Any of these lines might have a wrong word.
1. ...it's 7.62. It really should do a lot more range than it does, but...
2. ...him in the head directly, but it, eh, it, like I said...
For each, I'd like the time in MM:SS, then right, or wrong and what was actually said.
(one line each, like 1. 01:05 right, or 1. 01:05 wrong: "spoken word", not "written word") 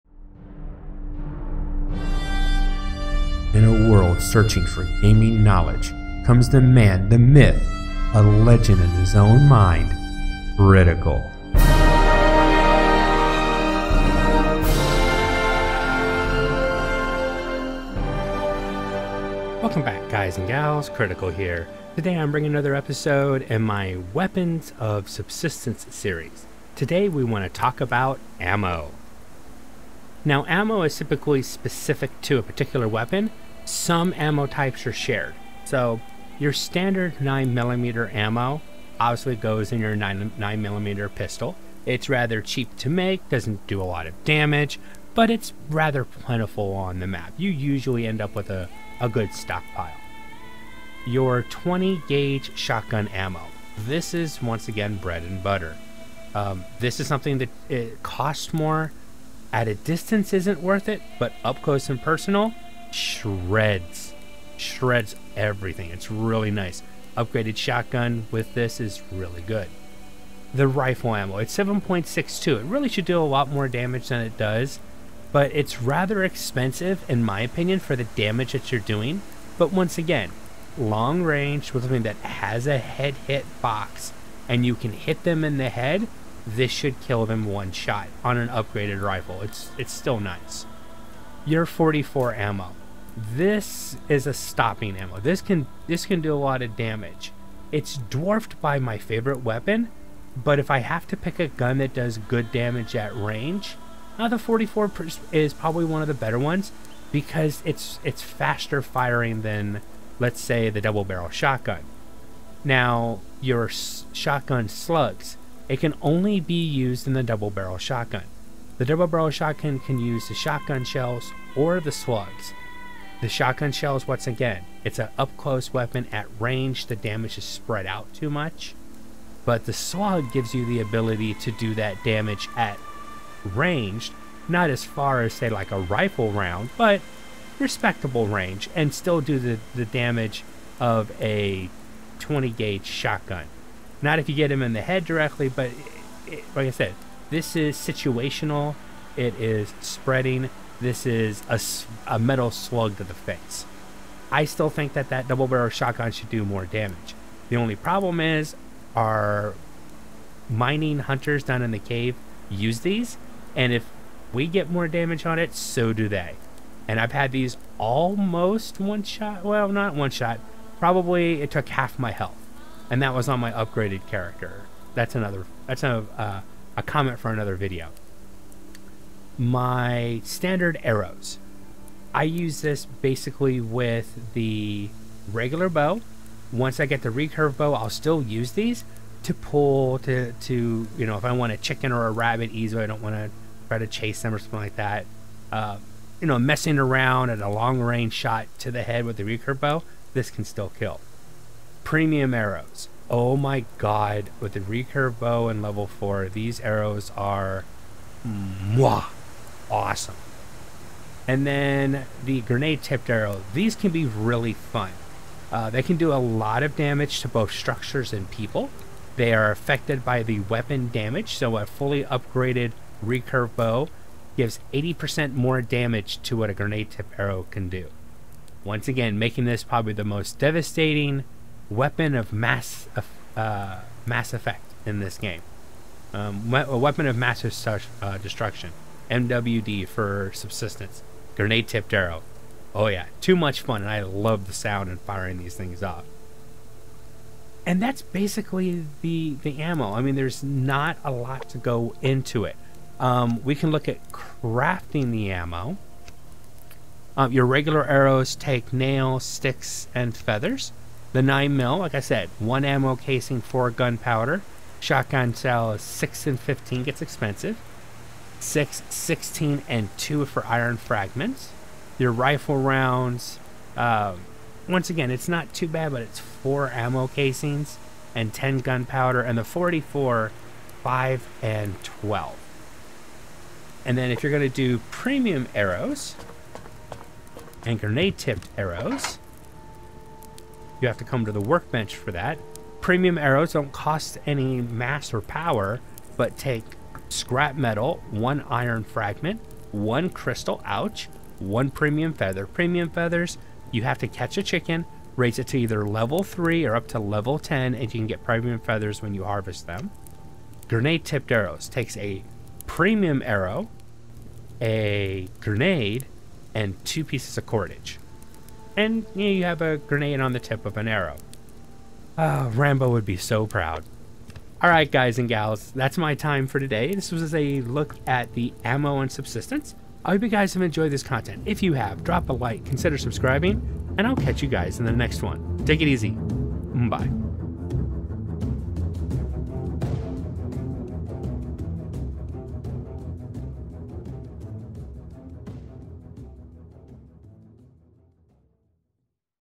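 1. 01:11 wrong: "damage", not "range"
2. 02:24 right.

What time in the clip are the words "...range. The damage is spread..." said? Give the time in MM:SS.
02:06.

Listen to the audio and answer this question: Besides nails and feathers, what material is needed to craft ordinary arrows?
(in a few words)
sticks.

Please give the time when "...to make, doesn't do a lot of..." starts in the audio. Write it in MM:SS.
00:42.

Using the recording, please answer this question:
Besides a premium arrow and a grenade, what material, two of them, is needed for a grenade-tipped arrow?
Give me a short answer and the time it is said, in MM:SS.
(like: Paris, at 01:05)
cordage, at 05:17.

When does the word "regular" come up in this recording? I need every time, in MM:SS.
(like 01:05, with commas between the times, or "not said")
03:05, 04:17.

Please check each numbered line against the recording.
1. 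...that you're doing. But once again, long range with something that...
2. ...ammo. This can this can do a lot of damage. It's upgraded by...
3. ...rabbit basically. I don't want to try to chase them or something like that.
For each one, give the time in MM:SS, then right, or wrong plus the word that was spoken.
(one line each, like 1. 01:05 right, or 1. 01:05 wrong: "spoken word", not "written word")
1. 01:18 right
2. 01:34 wrong: "dwarfed", not "upgraded"
3. 03:12 wrong: "easily", not "basically".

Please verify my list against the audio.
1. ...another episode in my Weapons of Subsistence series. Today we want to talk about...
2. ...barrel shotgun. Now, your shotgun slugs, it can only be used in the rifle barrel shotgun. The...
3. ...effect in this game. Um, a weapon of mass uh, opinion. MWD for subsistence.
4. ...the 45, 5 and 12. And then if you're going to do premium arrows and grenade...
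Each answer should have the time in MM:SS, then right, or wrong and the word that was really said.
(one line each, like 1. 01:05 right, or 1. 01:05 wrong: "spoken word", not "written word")
1. 00:22 right
2. 01:51 wrong: "double", not "rifle"
3. 03:54 wrong: "destruction", not "opinion"
4. 04:39 wrong: "44", not "45".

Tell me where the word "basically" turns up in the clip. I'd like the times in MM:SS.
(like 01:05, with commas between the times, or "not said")
03:02, 04:08.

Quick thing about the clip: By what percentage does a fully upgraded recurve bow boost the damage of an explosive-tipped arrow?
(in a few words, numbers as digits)
80%.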